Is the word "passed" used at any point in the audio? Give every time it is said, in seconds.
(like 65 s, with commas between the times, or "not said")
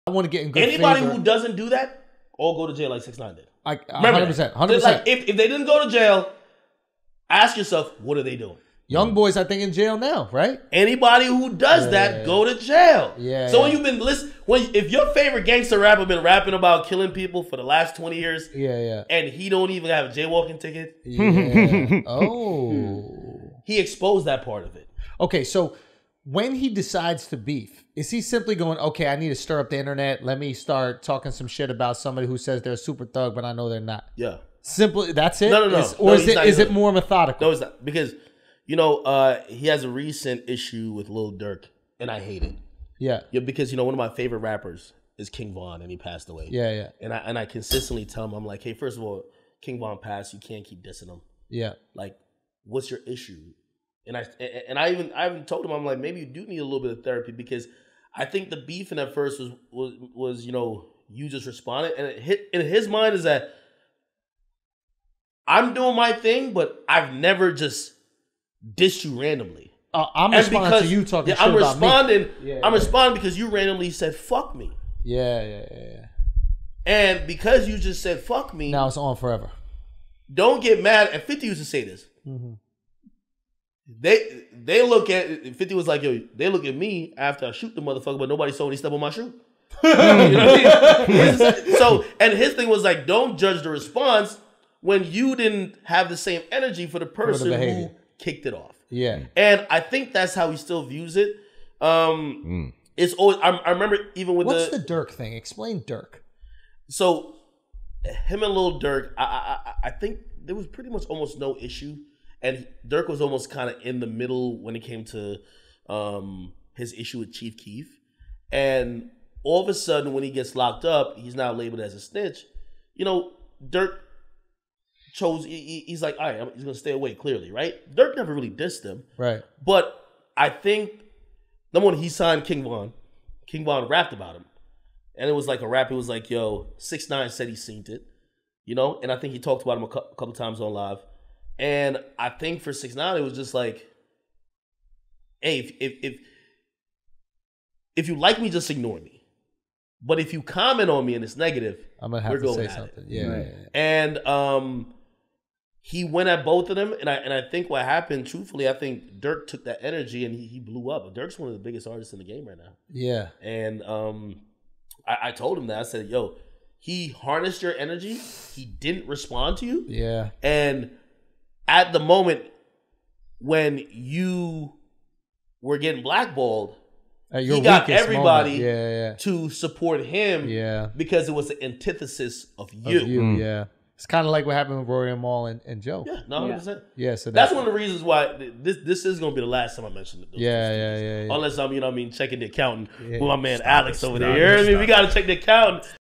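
45 s, 49 s.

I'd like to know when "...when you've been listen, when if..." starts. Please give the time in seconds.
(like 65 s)
13 s.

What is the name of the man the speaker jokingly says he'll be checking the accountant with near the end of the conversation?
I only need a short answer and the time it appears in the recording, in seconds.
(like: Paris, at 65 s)
Alex, at 193 s.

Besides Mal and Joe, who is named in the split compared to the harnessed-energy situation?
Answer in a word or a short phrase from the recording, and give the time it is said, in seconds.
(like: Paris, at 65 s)
Rory, at 184 s.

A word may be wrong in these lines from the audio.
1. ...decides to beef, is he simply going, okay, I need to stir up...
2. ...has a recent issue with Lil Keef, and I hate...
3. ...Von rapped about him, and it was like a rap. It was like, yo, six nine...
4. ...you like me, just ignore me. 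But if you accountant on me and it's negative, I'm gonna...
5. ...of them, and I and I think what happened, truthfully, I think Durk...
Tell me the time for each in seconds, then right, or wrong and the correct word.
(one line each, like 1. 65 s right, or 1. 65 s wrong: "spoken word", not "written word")
1. 26 s right
2. 39 s wrong: "Durk", not "Keef"
3. 133 s right
4. 148 s wrong: "comment", not "accountant"
5. 156 s right.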